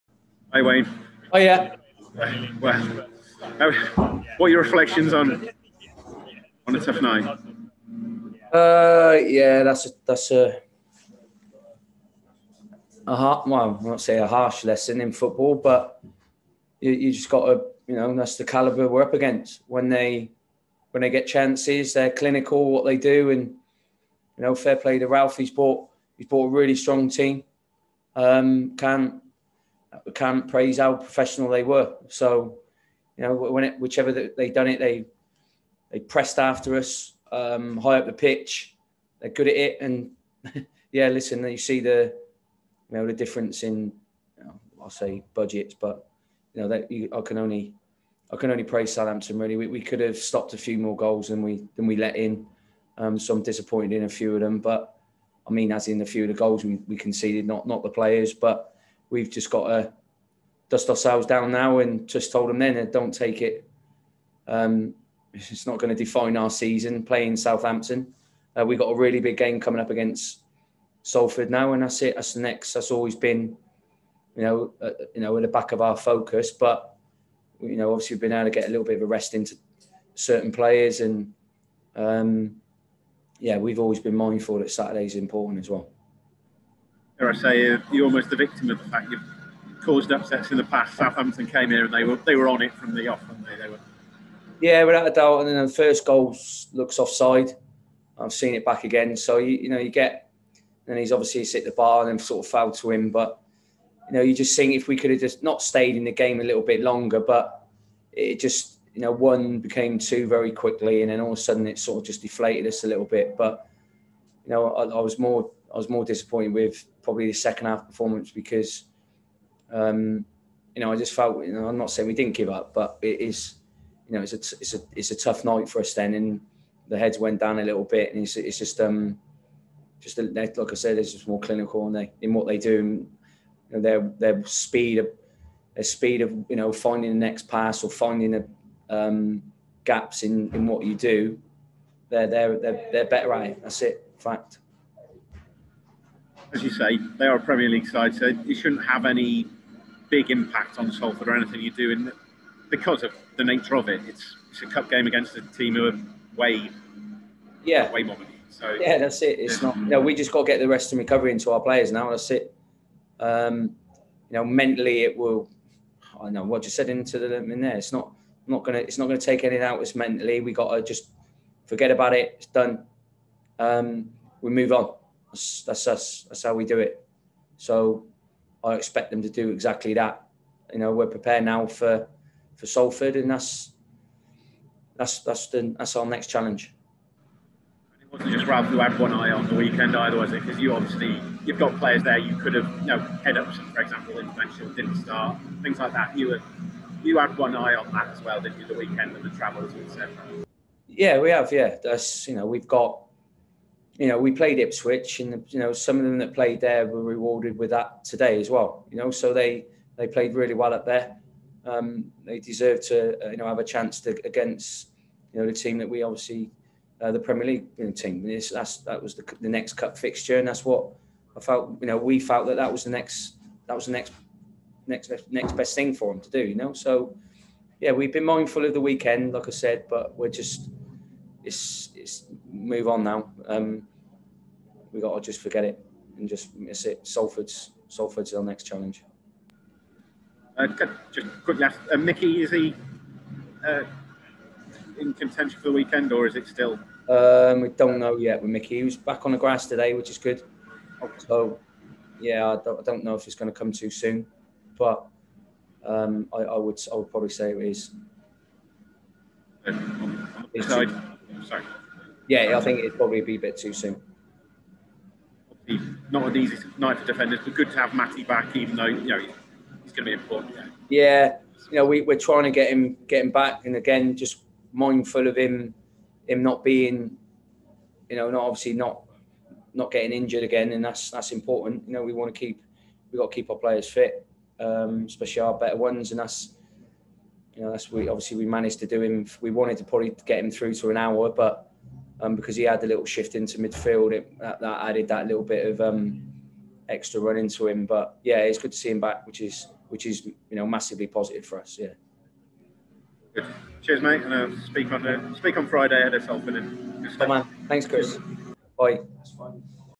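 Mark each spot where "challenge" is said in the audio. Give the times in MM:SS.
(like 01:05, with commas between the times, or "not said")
03:06, 03:58.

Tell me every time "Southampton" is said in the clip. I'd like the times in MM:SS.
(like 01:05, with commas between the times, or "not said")
00:48, 01:07, 01:30.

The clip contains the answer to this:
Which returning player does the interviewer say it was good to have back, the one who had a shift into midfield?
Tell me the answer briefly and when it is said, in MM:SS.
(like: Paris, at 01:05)
Matty, at 04:27.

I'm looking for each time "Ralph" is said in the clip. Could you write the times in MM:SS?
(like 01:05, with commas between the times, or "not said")
00:25, 03:08.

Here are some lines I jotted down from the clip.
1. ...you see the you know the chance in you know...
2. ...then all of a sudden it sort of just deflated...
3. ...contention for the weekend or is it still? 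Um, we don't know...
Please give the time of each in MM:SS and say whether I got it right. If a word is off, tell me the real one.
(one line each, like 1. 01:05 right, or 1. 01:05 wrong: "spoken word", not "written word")
1. 00:41 wrong: "difference", not "chance"
2. 01:51 right
3. 04:05 right.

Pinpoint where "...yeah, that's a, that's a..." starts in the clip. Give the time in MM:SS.
00:09.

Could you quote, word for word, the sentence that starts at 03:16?
You were you had one eye on that as well, didn't you?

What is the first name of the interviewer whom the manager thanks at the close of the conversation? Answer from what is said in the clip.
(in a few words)
Chris.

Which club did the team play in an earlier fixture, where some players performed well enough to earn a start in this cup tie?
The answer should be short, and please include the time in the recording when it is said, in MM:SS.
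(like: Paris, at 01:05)
Ipswich, at 03:24.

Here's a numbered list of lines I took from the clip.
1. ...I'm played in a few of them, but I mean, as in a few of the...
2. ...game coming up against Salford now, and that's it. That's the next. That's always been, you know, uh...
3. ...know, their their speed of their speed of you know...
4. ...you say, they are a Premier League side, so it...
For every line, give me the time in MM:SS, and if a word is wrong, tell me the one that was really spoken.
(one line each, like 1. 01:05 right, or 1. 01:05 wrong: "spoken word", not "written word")
1. 00:53 wrong: "disappointed", not "played"
2. 01:09 right
3. 02:13 right
4. 02:26 right.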